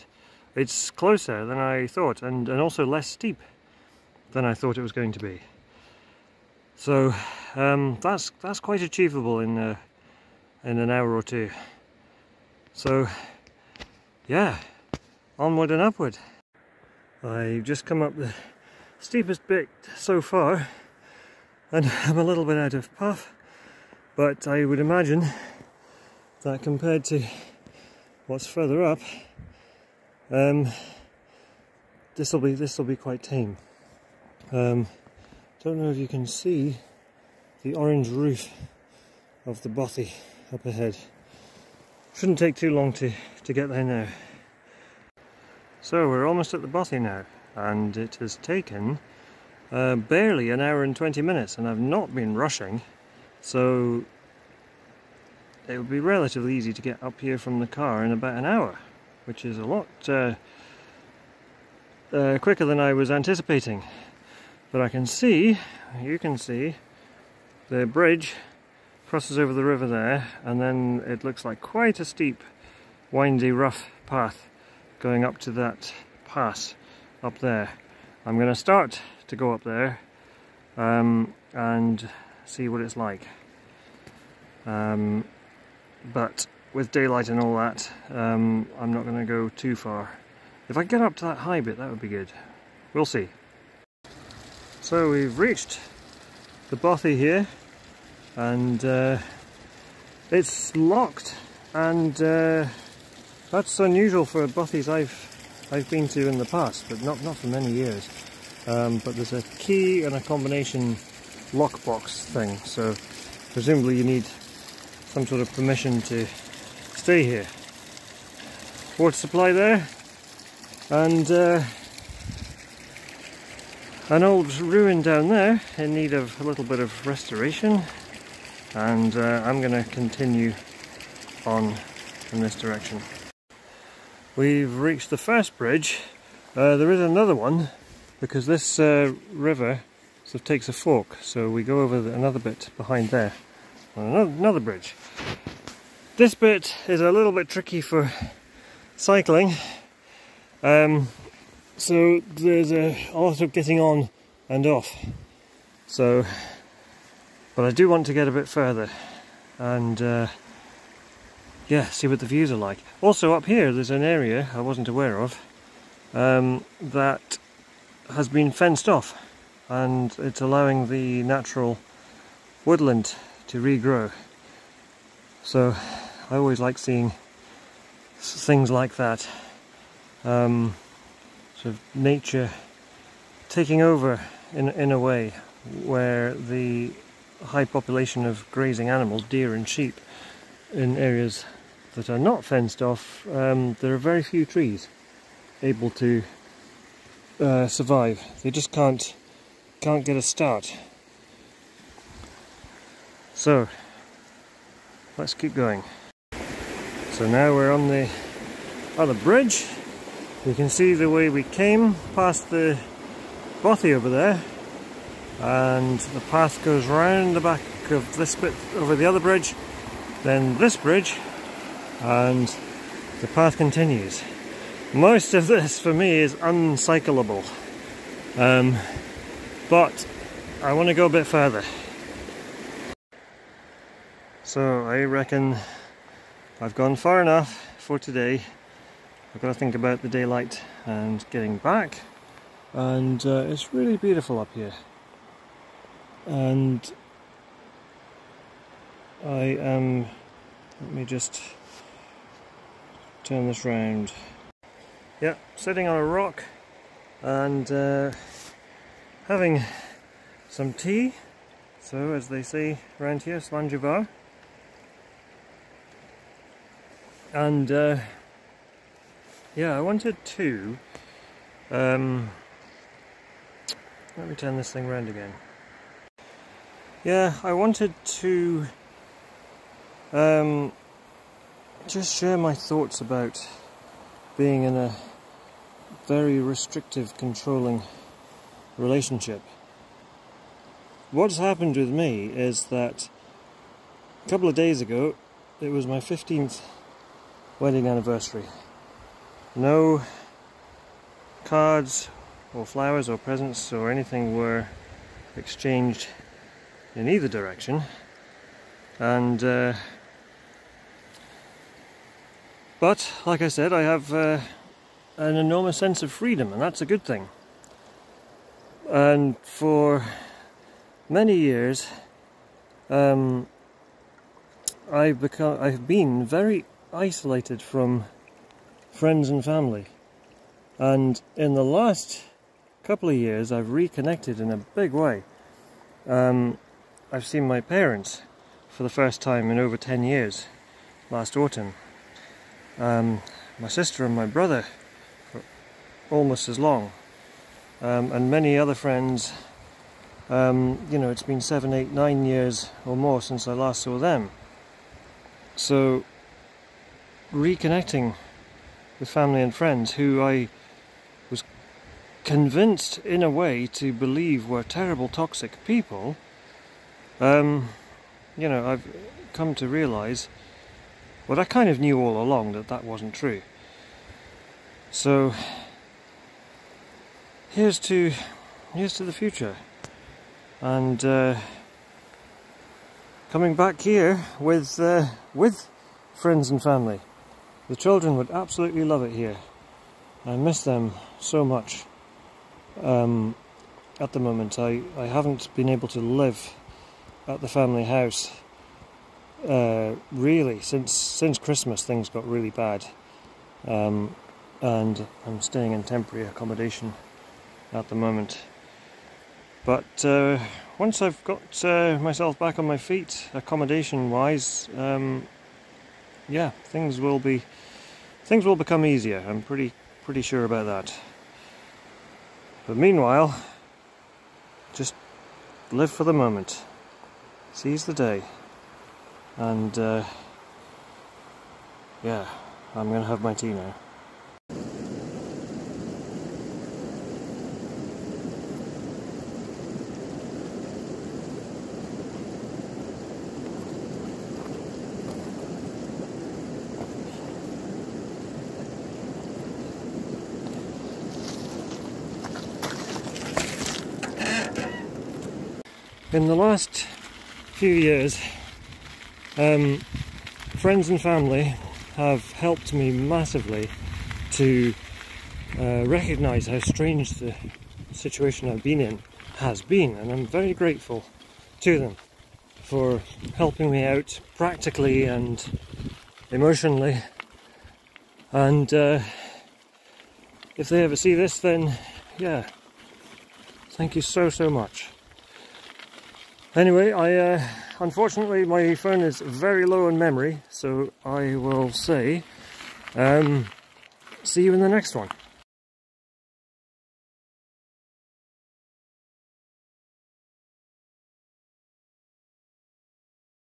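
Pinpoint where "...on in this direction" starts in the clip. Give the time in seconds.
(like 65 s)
131 s.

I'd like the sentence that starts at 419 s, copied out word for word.
I'm pretty pretty sure about that.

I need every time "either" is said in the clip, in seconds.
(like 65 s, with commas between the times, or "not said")
307 s.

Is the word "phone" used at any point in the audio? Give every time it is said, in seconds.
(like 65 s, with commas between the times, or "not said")
488 s.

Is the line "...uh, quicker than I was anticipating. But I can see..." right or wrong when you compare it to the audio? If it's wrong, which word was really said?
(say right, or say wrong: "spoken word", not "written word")
right.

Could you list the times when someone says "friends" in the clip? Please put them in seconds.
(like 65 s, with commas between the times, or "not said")
328 s, 348 s, 359 s, 386 s, 460 s.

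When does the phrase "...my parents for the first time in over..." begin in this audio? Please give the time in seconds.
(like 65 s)
337 s.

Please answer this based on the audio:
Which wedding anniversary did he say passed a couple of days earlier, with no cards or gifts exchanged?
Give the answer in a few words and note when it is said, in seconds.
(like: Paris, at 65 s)
15th, at 295 s.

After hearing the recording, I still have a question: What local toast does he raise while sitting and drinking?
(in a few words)
slàinte mhath.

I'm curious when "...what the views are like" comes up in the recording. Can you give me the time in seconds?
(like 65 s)
162 s.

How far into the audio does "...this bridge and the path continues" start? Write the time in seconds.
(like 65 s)
220 s.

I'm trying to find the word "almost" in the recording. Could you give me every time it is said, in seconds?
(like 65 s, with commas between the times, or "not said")
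46 s, 346 s.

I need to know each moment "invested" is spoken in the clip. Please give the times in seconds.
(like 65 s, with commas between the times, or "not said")
not said.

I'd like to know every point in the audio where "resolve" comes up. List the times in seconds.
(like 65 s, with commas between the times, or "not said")
not said.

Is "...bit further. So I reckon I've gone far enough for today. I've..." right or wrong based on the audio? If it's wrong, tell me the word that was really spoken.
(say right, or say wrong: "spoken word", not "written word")
right.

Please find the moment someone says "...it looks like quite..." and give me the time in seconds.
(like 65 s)
71 s.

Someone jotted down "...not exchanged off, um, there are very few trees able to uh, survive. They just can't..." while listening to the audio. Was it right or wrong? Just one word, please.
wrong.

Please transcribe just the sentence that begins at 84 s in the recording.
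Um, but with daylight and all that, um, I'm not going to go too far.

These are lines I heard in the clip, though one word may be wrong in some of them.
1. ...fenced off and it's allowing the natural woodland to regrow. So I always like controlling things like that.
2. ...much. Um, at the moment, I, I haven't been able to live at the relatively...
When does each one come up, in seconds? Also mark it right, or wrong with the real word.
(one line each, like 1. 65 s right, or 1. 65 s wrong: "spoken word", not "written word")
1. 168 s wrong: "seeing", not "controlling"
2. 391 s wrong: "family", not "relatively".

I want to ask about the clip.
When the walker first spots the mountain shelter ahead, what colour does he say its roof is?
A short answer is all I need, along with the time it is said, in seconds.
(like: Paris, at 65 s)
orange, at 37 s.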